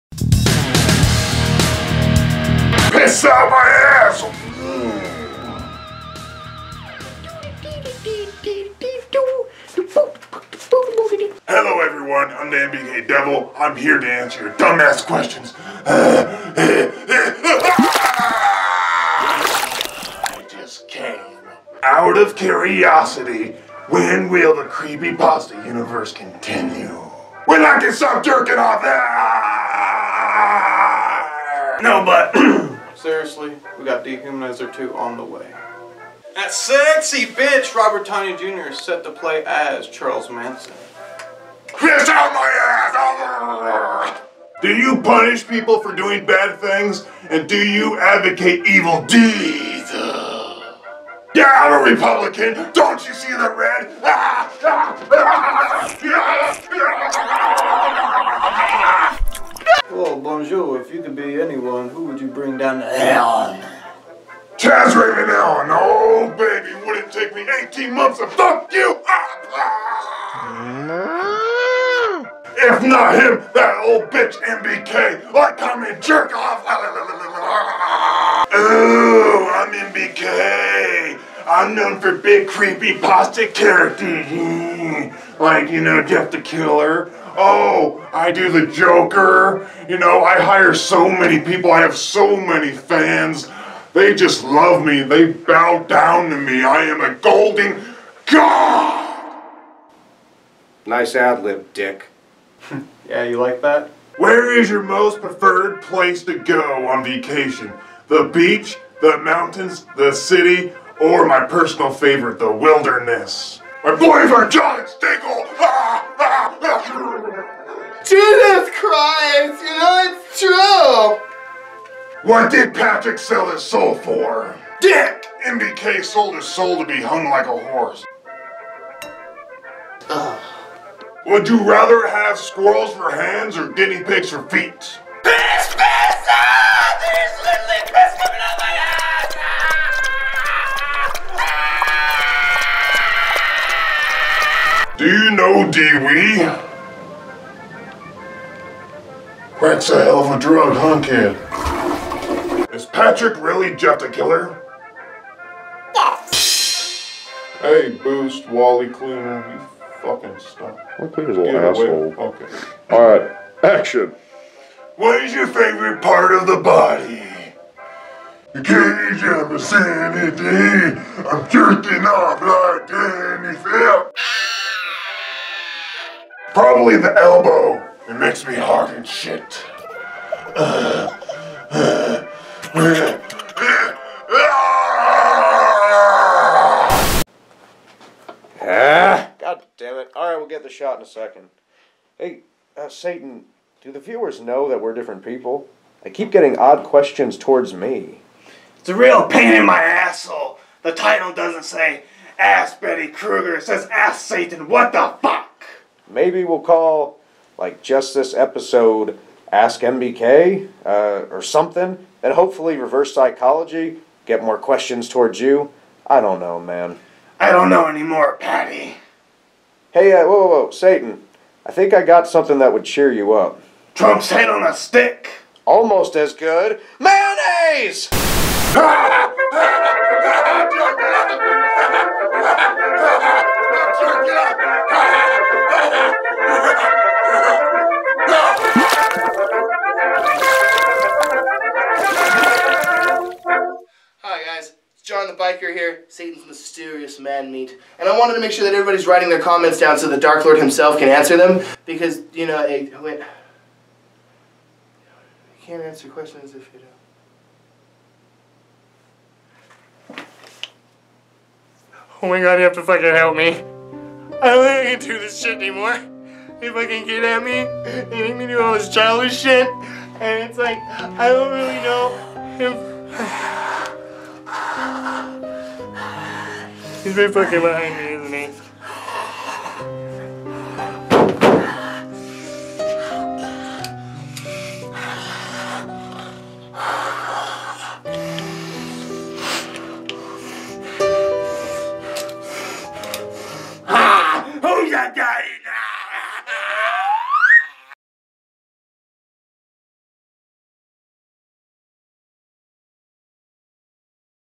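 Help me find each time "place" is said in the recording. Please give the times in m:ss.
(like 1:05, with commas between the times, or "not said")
1:45.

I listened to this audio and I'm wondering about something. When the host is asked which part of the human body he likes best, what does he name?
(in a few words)
The elbow.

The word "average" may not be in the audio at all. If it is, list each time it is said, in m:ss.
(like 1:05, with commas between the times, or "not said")
not said.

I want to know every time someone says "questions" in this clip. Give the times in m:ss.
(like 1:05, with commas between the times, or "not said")
0:15, 3:16, 3:34, 4:16.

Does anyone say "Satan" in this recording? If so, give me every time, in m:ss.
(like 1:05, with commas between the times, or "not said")
3:12, 3:24, 3:40, 4:06.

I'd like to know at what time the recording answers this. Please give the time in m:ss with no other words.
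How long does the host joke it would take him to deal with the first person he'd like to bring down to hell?
1:07.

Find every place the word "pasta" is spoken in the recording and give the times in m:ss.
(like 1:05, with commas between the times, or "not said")
0:25, 1:22.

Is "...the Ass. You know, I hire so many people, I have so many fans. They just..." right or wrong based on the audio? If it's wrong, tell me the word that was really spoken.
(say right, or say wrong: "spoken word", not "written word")
wrong: "Joker", not "Ass".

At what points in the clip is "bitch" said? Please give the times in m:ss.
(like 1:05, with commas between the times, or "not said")
0:37, 1:14.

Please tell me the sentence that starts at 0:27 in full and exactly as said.
When I can stop jerking off that!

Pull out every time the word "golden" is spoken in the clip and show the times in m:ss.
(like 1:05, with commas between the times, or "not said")
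1:37.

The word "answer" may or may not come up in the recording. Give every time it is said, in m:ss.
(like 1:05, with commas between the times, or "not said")
0:14, 4:11, 4:15.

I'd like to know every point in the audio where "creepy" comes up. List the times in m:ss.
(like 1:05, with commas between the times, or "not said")
0:24, 1:22.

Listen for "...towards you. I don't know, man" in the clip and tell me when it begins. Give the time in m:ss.
3:35.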